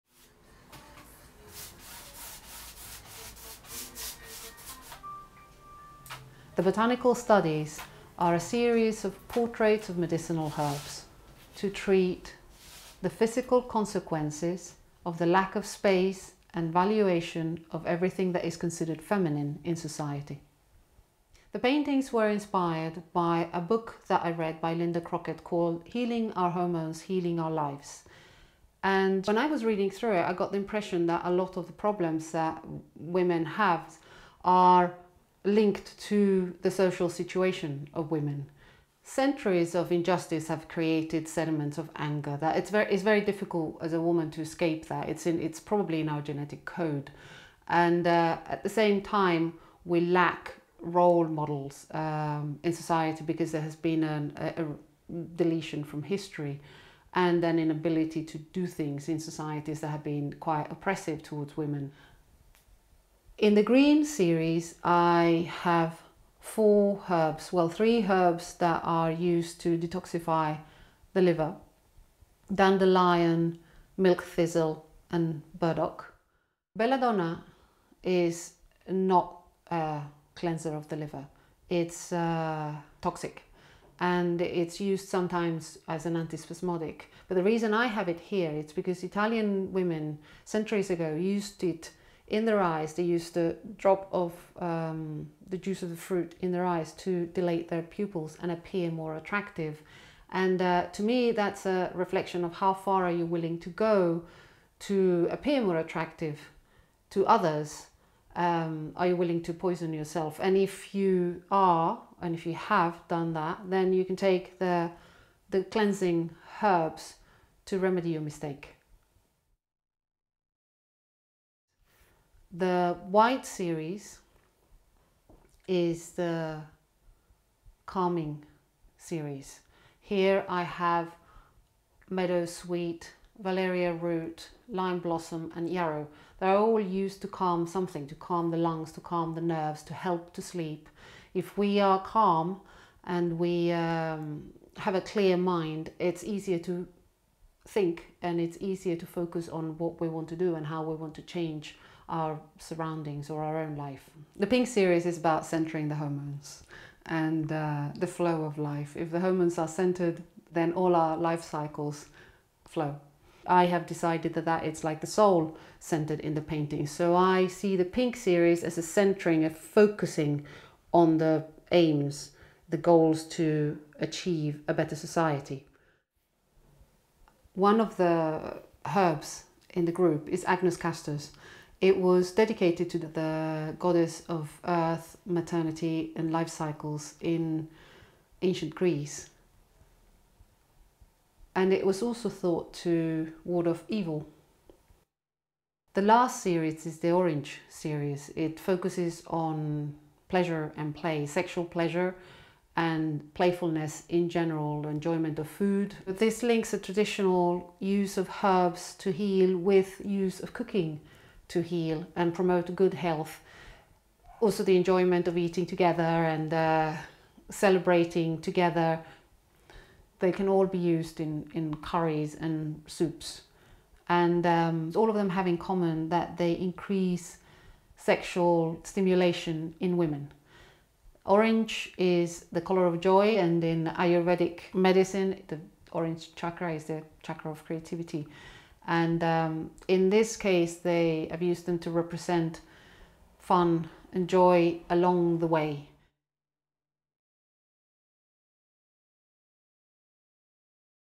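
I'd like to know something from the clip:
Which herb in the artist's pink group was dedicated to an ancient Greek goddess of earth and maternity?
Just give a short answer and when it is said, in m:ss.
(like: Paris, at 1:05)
Agnus castus, at 3:00.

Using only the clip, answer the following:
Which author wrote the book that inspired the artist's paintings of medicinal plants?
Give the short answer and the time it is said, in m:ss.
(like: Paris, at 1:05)
Linda Crockett, at 0:24.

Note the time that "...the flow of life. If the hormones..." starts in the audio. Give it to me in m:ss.
2:37.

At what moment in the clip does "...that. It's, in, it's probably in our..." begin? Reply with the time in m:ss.
0:44.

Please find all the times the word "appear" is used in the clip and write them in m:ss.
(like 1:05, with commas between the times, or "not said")
1:38, 1:45.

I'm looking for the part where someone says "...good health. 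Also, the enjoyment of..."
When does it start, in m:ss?
3:32.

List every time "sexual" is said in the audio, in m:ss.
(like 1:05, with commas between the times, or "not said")
3:21, 3:47.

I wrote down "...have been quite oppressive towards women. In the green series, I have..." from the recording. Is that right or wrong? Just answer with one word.
right.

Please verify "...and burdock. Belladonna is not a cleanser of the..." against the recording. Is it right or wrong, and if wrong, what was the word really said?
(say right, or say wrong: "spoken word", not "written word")
right.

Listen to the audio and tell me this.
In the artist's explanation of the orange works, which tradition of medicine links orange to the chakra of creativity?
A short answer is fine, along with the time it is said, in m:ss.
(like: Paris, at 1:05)
Ayurvedic medicine, at 3:54.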